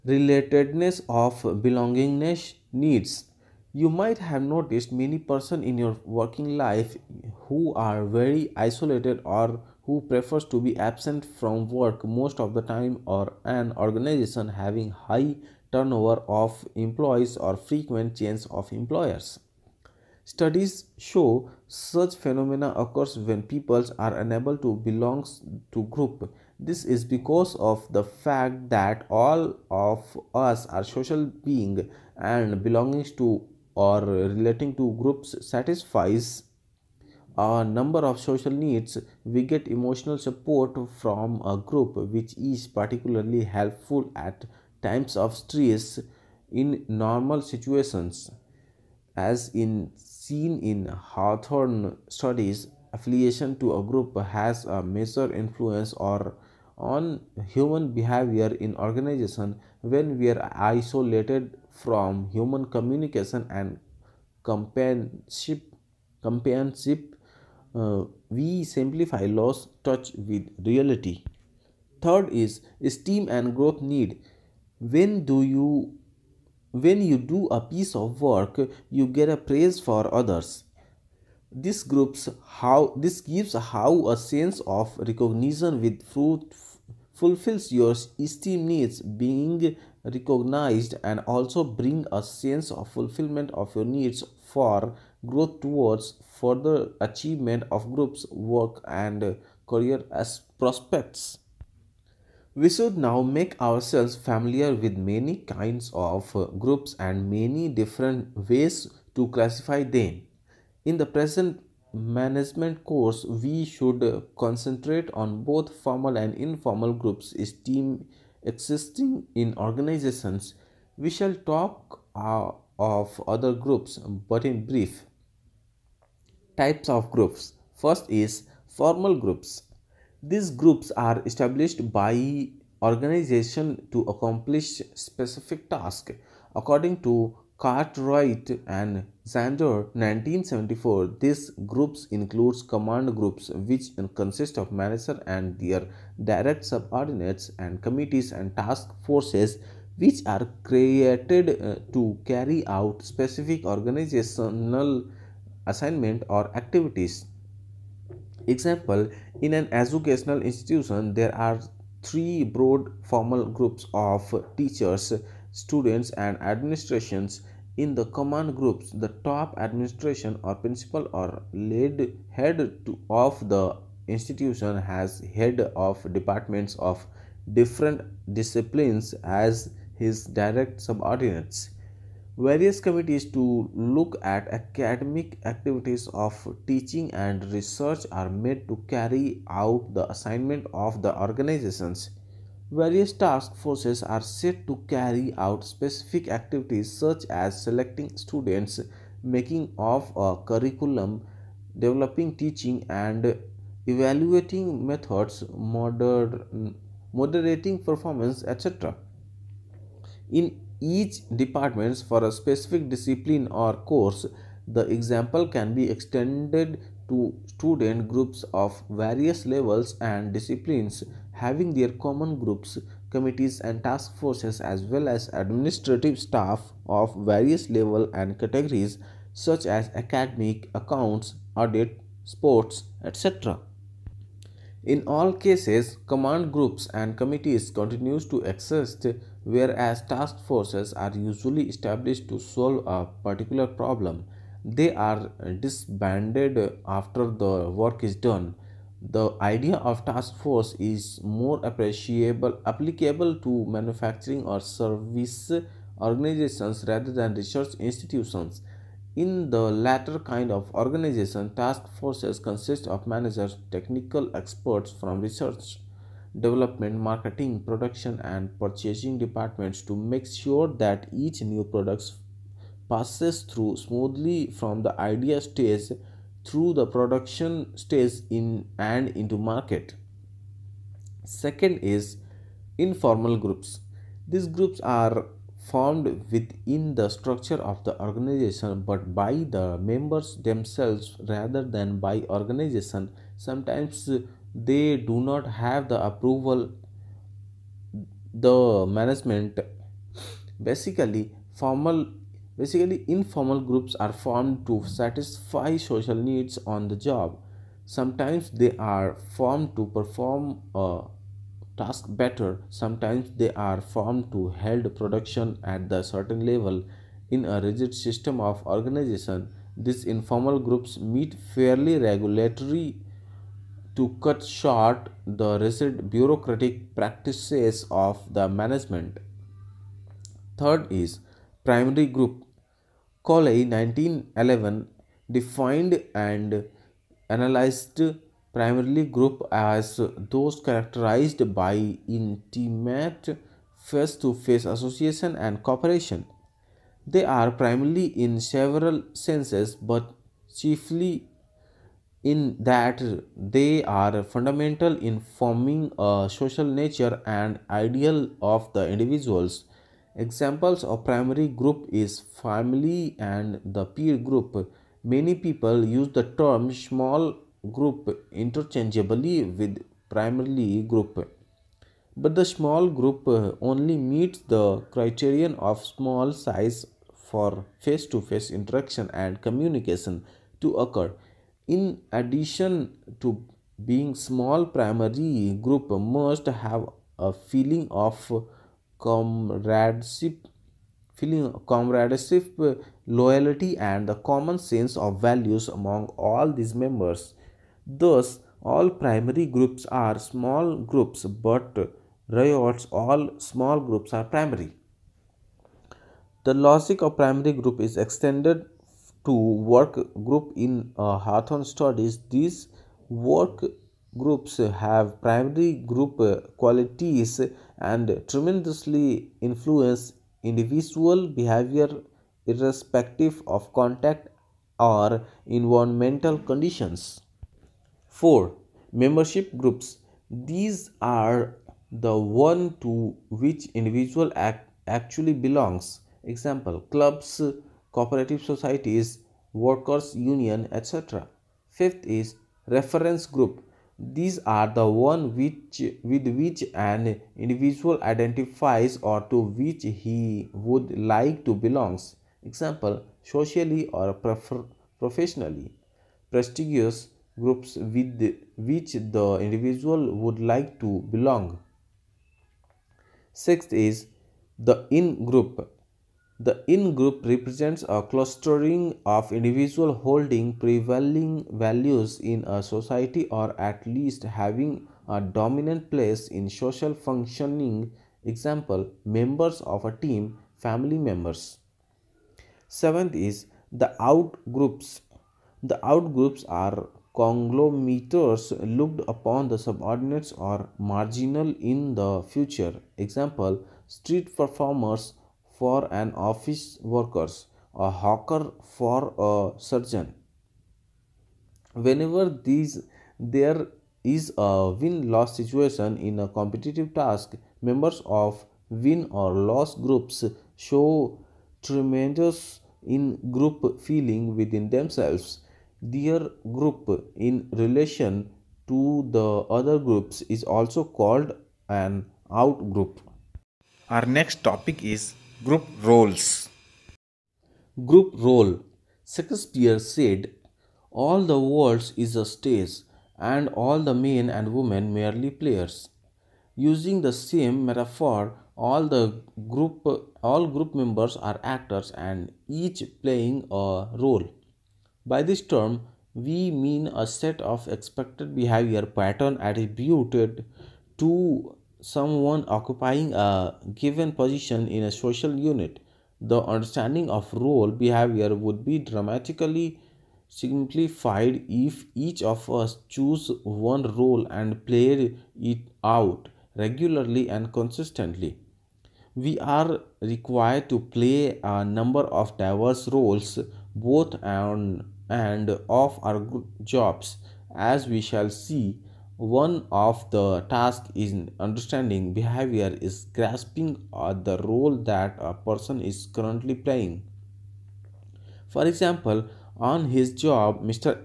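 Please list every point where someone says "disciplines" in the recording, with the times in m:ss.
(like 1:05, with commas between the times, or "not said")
2:58, 3:32, 3:40.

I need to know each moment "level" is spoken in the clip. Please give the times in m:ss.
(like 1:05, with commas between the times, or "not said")
3:39, 3:47, 5:16.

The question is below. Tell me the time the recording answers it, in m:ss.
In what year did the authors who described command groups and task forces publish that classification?
2:19.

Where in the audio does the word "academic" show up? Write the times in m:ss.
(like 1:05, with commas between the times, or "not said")
3:04, 3:49.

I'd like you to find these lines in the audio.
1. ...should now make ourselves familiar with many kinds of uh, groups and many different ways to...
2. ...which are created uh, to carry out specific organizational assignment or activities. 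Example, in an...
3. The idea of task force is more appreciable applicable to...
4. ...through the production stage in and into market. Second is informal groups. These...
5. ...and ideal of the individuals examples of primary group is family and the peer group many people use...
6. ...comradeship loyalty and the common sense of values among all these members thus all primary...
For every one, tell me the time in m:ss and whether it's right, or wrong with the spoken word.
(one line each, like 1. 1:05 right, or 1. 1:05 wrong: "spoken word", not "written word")
1. 1:42 right
2. 2:29 right
3. 4:09 right
4. 4:36 right
5. 5:57 right
6. 6:31 right.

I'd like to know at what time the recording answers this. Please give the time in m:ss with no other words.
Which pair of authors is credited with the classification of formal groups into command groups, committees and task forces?
2:17.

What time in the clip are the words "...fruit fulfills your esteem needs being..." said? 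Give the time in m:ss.
1:26.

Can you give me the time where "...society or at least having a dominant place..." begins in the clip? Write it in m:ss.
7:52.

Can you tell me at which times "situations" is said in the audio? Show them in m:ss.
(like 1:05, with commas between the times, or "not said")
0:47, 8:25.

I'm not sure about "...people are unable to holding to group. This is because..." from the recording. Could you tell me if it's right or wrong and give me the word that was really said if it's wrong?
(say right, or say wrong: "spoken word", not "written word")
wrong: "belong", not "holding".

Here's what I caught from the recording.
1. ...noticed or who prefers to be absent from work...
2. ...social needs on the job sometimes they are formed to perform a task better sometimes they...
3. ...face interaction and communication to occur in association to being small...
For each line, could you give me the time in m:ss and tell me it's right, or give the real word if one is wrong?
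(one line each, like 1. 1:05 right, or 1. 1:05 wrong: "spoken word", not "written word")
1. 0:08 wrong: "isolated", not "noticed"
2. 5:05 right
3. 6:18 wrong: "addition", not "association".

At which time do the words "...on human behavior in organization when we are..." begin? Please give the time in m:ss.
0:56.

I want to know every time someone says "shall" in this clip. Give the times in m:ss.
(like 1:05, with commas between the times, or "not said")
2:01, 9:38.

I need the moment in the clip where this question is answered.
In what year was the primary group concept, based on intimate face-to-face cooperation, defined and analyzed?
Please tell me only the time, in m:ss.
5:33.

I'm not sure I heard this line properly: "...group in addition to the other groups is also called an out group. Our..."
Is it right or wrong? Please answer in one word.
wrong.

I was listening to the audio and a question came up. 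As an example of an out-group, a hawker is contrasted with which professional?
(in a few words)
a surgeon.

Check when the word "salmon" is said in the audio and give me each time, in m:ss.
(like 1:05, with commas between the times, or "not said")
not said.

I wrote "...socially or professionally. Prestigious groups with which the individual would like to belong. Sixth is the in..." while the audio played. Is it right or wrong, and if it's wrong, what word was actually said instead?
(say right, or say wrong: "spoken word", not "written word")
right.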